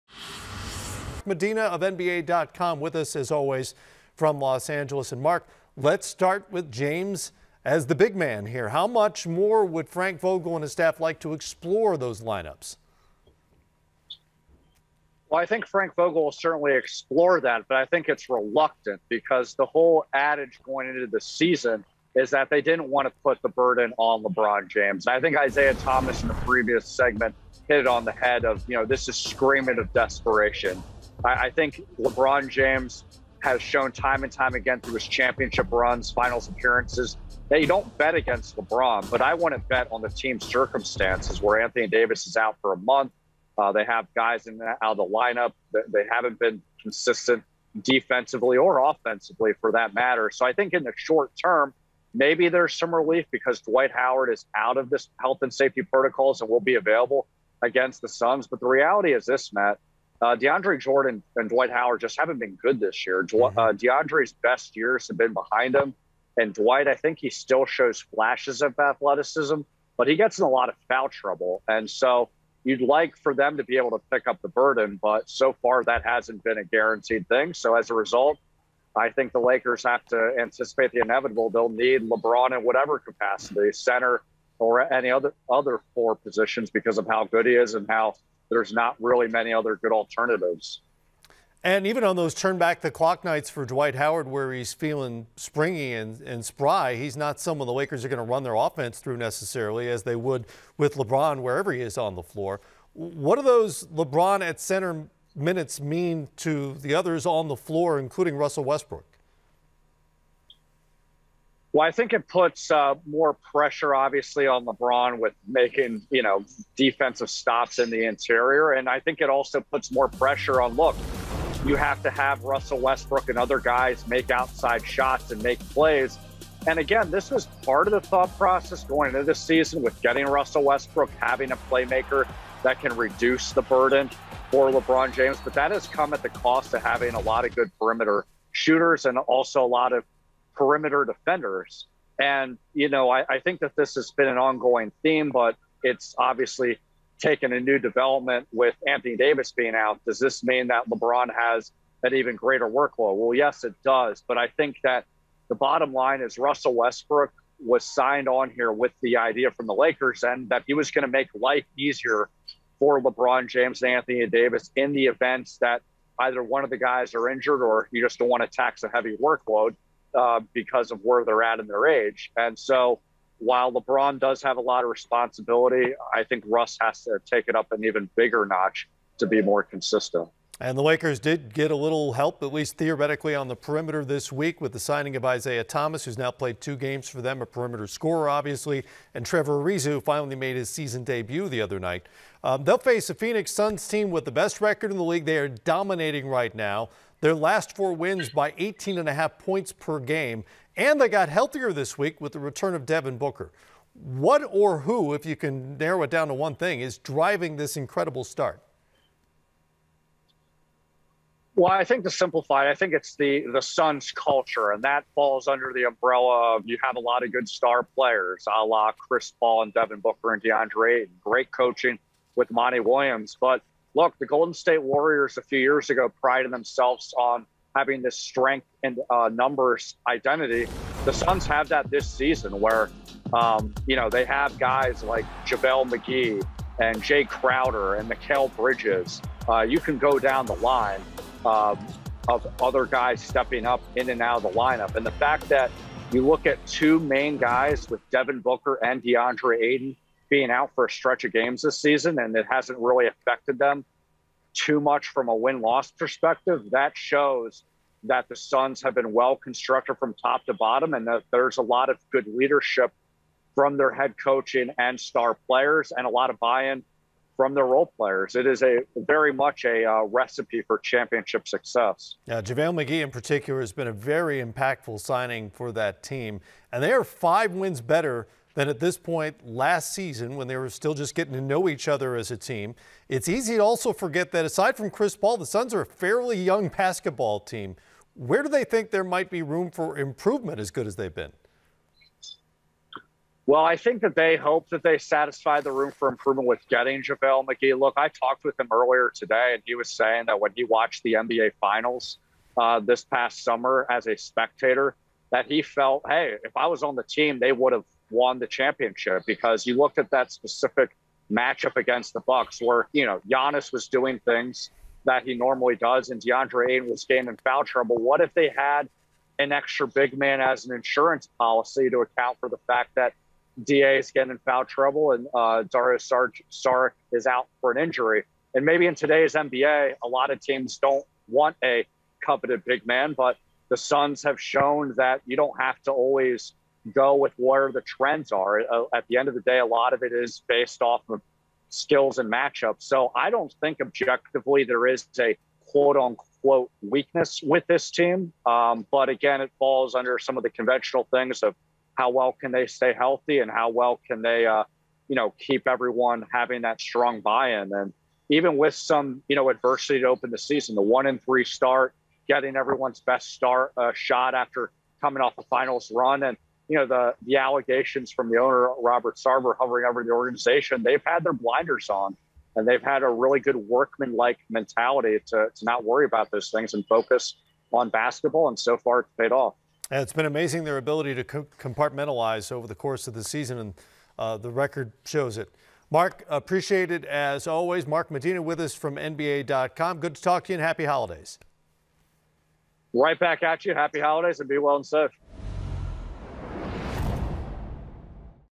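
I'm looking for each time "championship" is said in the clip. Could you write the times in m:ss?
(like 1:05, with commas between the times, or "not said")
0:35, 4:30, 5:08.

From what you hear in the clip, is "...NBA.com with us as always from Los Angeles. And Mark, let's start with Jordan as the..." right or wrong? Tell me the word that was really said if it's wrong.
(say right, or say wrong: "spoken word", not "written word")
wrong: "James", not "Jordan".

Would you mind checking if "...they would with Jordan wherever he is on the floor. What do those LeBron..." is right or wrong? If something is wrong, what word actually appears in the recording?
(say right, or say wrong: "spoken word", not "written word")
wrong: "LeBron", not "Jordan".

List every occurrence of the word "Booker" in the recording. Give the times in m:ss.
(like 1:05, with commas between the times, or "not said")
3:23, 3:39, 4:08.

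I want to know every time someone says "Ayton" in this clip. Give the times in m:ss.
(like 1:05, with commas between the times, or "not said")
4:09, 5:16.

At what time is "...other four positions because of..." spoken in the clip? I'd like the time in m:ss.
1:25.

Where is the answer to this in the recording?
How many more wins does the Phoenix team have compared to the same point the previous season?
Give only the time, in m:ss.
4:37.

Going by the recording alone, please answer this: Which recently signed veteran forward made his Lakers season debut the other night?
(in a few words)
Trevor Ariza.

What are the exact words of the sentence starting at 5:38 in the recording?
Uh, at the end of the day, a lot of it is based off of skills and matchups.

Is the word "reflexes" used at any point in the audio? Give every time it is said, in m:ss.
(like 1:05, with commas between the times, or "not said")
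not said.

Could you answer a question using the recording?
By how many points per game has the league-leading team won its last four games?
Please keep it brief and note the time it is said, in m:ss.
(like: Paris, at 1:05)
18.5, at 3:18.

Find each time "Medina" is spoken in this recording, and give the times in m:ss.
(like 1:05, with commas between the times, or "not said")
0:01, 6:28.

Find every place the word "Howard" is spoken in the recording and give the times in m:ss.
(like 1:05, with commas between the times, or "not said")
0:53, 1:01, 1:33.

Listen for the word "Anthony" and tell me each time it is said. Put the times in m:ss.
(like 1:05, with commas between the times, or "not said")
0:41, 2:28, 2:43.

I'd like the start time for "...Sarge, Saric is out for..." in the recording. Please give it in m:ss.
5:25.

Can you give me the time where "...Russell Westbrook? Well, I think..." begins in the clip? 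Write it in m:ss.
1:48.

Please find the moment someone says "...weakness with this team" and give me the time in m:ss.
5:46.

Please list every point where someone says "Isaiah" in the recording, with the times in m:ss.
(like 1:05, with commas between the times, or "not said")
0:25, 3:05.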